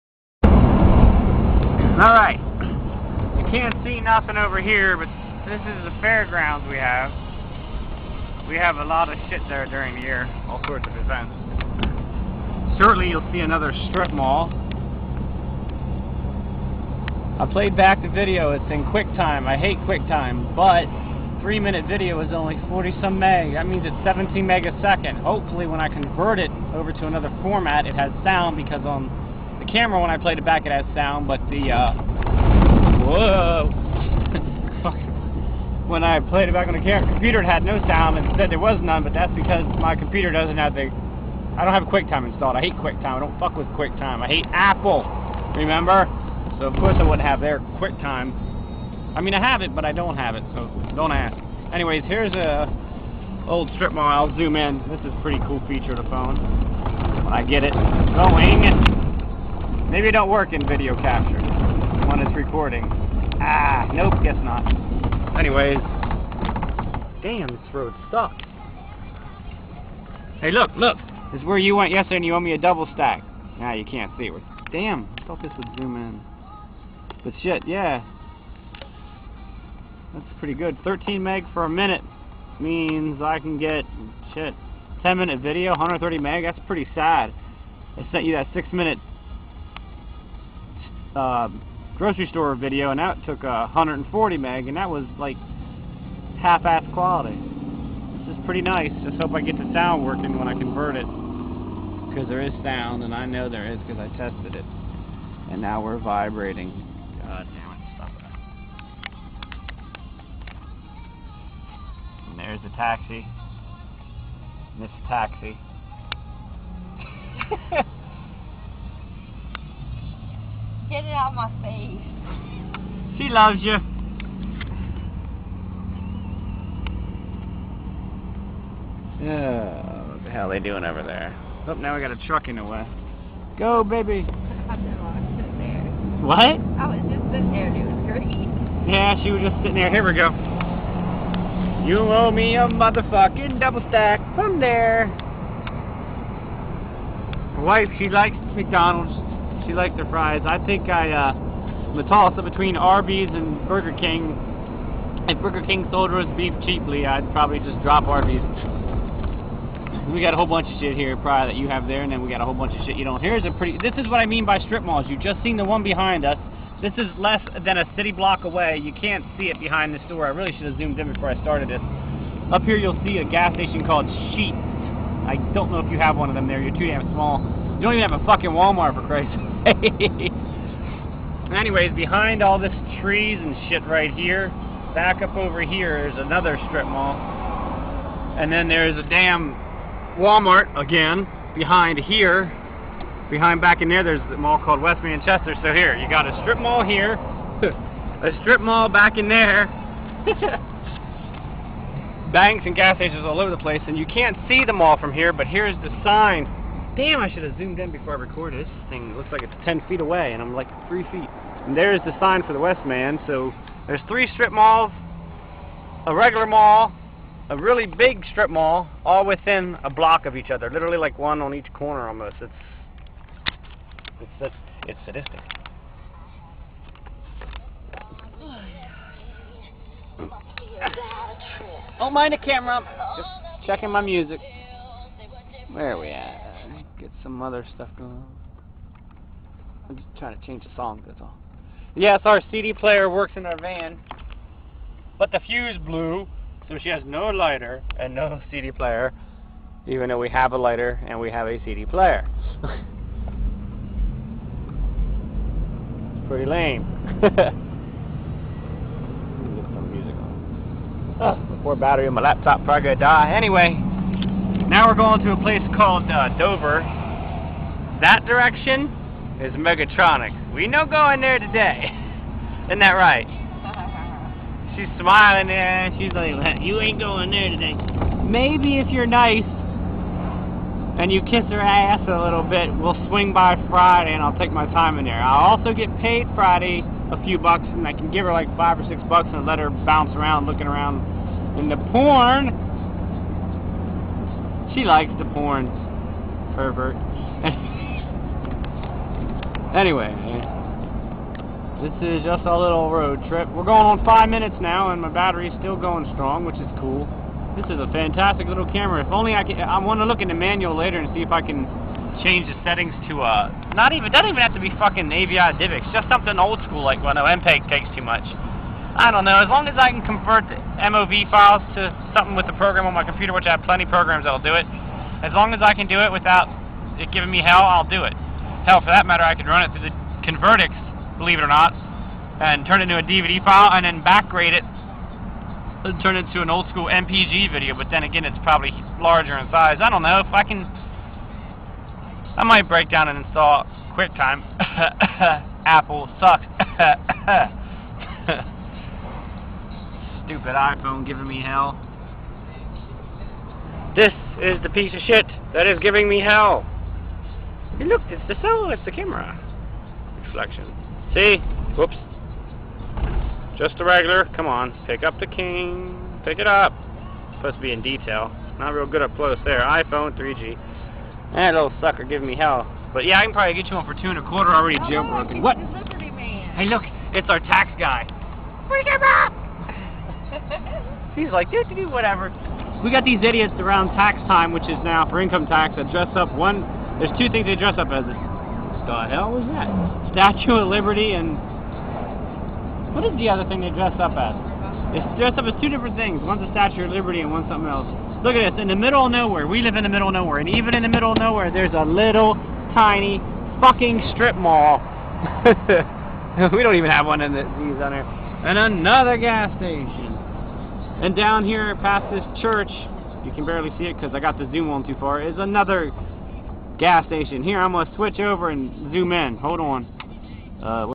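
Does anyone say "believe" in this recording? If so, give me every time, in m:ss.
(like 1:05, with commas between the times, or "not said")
5:31.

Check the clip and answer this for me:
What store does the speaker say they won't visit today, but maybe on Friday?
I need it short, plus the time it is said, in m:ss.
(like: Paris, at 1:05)
Megatronic, at 4:29.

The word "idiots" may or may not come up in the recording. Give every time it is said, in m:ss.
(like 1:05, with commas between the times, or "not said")
6:23.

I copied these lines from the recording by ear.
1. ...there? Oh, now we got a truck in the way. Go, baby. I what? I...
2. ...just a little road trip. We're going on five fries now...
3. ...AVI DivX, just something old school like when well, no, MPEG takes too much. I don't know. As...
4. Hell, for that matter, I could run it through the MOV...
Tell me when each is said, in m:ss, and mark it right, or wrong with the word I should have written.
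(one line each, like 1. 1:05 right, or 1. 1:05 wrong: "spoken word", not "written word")
1. 2:11 right
2. 5:02 wrong: "minutes", not "fries"
3. 5:15 right
4. 5:28 wrong: "Convertix", not "MOV".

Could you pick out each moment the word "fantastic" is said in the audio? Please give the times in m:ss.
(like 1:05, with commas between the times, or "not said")
5:07.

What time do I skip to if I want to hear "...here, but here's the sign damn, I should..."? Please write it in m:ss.
3:25.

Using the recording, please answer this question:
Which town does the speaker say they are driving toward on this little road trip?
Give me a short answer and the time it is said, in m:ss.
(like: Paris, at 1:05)
Dover, at 4:26.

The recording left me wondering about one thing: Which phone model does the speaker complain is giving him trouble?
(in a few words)
iPhone 3G.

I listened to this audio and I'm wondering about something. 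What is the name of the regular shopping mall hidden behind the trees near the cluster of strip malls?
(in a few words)
West Manchester.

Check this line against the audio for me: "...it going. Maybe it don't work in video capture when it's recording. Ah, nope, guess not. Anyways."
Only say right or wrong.
right.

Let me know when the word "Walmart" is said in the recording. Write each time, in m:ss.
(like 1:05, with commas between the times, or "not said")
2:58, 3:10.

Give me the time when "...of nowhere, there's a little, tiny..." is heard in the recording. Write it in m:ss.
6:41.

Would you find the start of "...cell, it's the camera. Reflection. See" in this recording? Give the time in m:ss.
5:58.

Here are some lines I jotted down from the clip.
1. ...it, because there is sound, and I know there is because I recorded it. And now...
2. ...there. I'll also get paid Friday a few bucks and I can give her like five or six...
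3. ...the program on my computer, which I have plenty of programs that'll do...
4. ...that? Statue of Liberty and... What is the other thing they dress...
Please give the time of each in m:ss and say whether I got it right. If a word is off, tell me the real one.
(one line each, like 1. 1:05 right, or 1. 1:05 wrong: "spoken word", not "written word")
1. 1:40 wrong: "tested", not "recorded"
2. 4:45 right
3. 5:22 right
4. 6:29 right.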